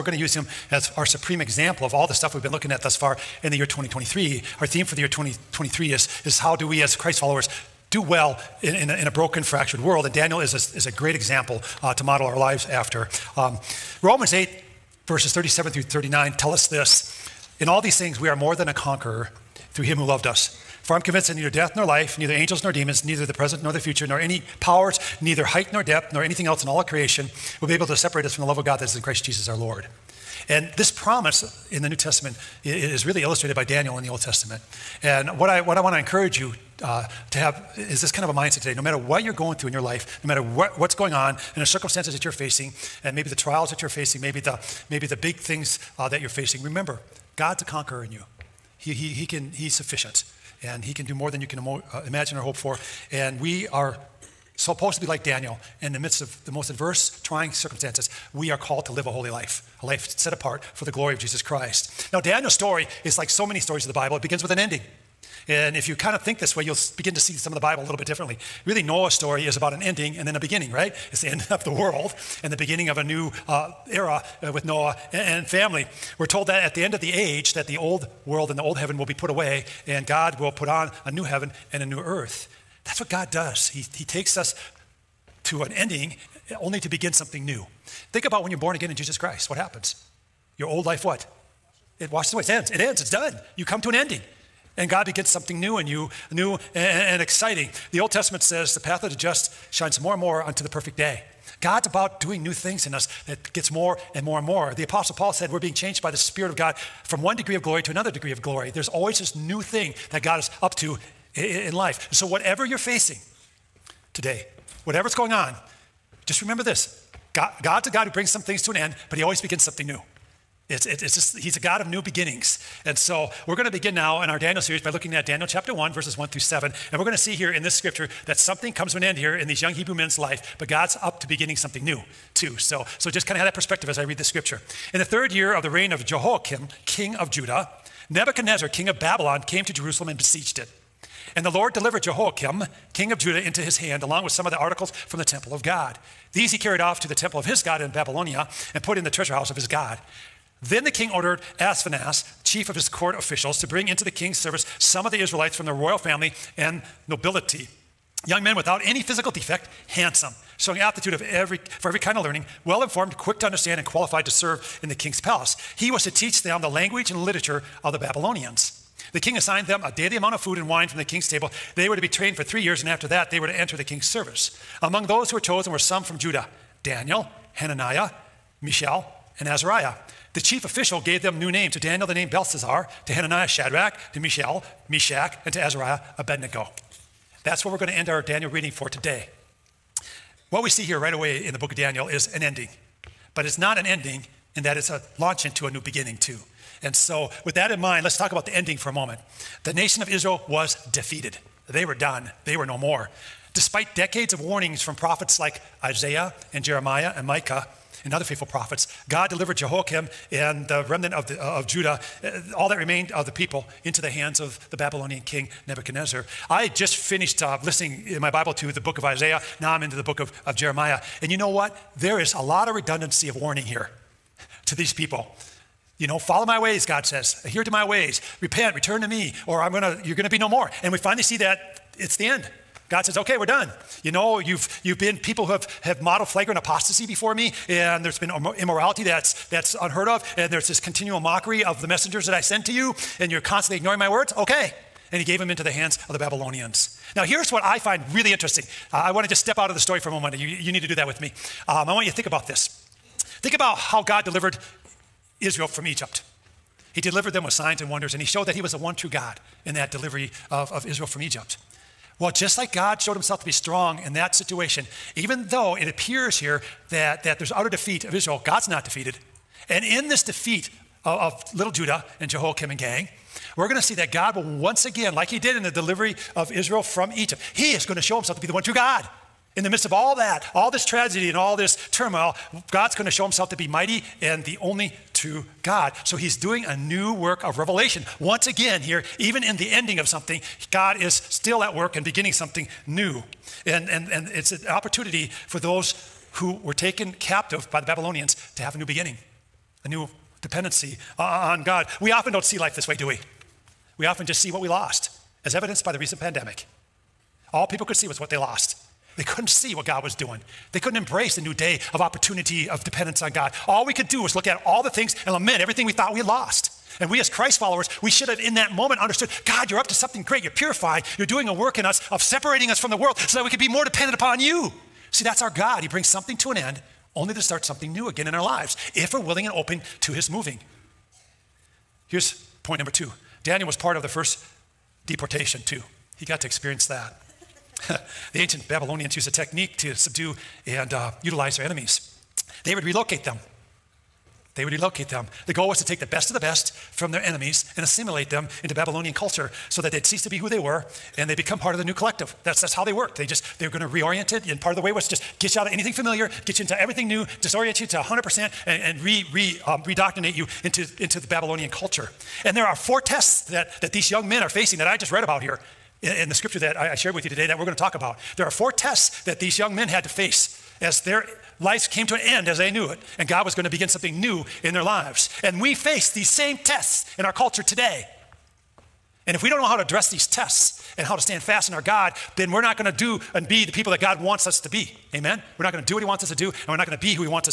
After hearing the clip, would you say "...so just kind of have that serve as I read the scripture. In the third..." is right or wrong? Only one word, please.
wrong.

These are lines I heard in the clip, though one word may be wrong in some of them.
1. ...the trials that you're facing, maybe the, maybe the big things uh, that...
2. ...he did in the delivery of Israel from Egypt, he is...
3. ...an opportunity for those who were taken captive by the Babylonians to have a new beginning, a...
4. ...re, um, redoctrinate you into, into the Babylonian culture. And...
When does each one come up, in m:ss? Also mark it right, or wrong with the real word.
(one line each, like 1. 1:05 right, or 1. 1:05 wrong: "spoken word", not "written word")
1. 0:43 right
2. 4:35 right
3. 4:54 right
4. 5:59 right.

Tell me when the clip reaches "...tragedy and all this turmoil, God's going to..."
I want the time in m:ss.
4:40.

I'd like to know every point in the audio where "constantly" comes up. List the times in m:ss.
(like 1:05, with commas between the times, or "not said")
4:03.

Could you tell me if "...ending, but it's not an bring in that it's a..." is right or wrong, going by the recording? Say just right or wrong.
wrong.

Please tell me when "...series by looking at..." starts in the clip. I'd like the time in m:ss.
2:04.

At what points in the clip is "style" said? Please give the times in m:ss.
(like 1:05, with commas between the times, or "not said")
not said.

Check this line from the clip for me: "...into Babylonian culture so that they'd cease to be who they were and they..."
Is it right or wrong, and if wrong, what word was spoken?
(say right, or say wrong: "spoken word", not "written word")
right.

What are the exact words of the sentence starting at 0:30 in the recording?
And this promise in the New Testament is really illustrated by Daniel in the Old Testament.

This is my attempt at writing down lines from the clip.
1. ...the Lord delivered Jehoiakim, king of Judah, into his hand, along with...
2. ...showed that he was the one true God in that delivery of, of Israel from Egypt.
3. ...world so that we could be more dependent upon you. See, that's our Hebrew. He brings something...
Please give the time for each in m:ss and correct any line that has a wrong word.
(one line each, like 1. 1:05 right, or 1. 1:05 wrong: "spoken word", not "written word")
1. 2:21 right
2. 4:18 right
3. 5:22 wrong: "God", not "Hebrew".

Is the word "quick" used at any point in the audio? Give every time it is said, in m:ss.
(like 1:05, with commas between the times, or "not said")
2:43.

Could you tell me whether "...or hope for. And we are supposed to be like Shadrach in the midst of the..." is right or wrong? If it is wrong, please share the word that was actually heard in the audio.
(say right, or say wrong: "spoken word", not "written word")
wrong: "Daniel", not "Shadrach".